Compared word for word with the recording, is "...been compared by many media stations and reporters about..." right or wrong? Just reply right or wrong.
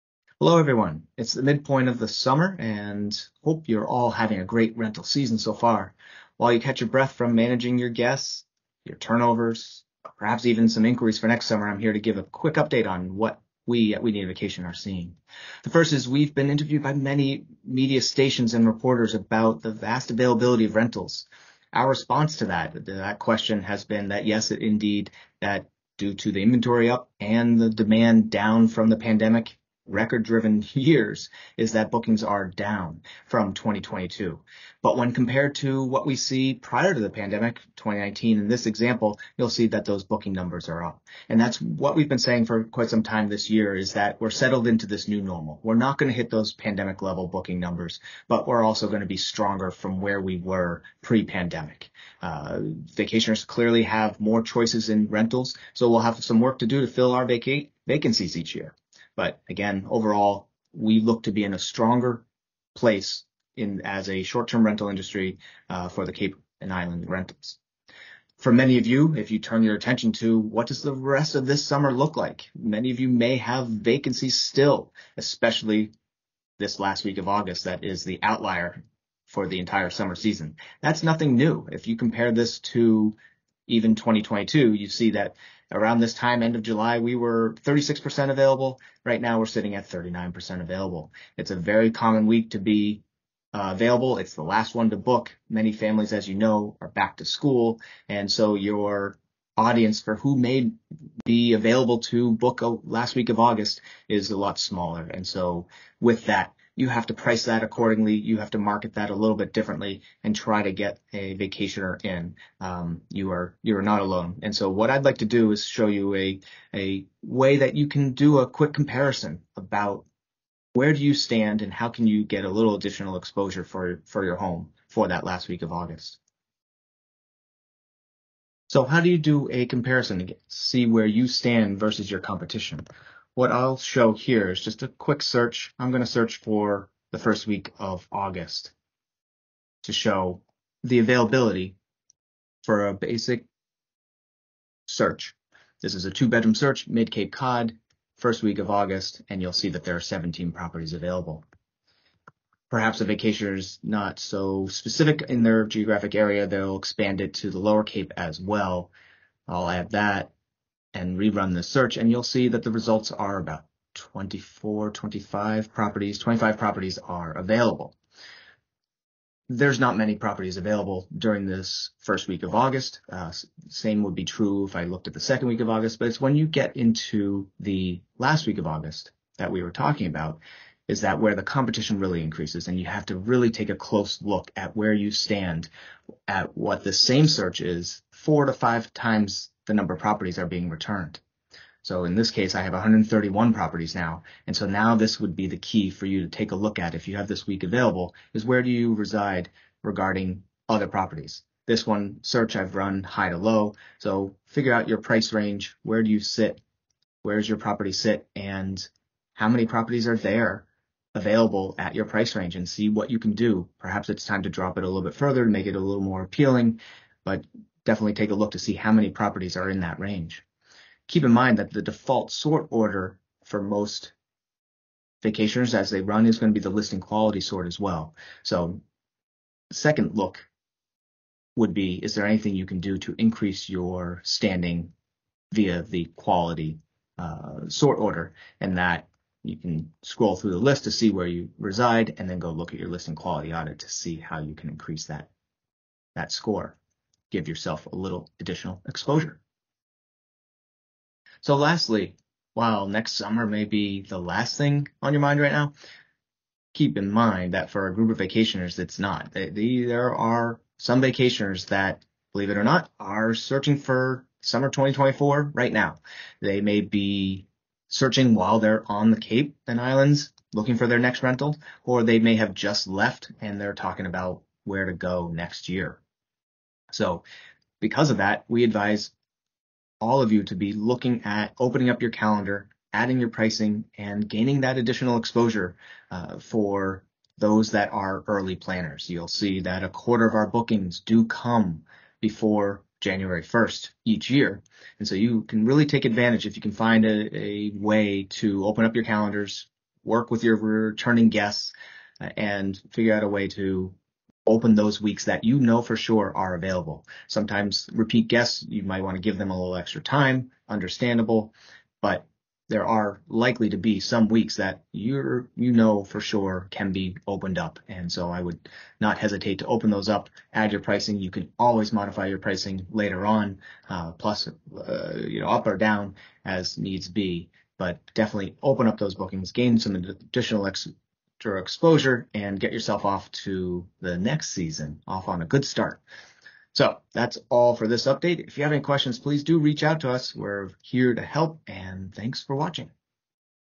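wrong.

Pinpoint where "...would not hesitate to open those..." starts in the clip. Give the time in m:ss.
5:18.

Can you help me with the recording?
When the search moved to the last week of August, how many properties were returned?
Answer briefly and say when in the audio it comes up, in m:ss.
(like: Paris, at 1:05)
131, at 3:12.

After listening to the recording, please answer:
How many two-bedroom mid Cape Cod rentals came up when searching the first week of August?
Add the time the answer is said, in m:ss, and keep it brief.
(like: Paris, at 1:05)
17, at 2:30.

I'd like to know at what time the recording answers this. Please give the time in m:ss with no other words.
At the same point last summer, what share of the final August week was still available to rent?
1:27.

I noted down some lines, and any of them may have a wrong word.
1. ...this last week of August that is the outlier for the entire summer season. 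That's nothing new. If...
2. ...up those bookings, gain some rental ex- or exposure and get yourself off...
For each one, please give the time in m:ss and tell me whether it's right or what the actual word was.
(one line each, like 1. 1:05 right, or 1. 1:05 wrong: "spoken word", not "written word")
1. 1:16 right
2. 5:28 wrong: "additional", not "rental".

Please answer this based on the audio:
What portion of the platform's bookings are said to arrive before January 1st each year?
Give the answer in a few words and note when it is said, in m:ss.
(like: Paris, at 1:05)
a quarter, at 4:49.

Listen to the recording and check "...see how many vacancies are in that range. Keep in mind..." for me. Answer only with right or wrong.
wrong.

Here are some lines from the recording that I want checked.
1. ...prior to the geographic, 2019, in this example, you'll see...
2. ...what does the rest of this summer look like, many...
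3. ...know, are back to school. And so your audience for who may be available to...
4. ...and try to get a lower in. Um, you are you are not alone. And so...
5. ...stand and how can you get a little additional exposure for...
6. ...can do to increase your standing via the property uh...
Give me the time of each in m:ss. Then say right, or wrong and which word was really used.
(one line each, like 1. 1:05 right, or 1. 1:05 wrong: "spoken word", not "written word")
1. 0:36 wrong: "pandemic", not "geographic"
2. 1:10 right
3. 1:36 right
4. 1:50 wrong: "vacationer", not "lower"
5. 2:01 right
6. 3:52 wrong: "quality", not "property".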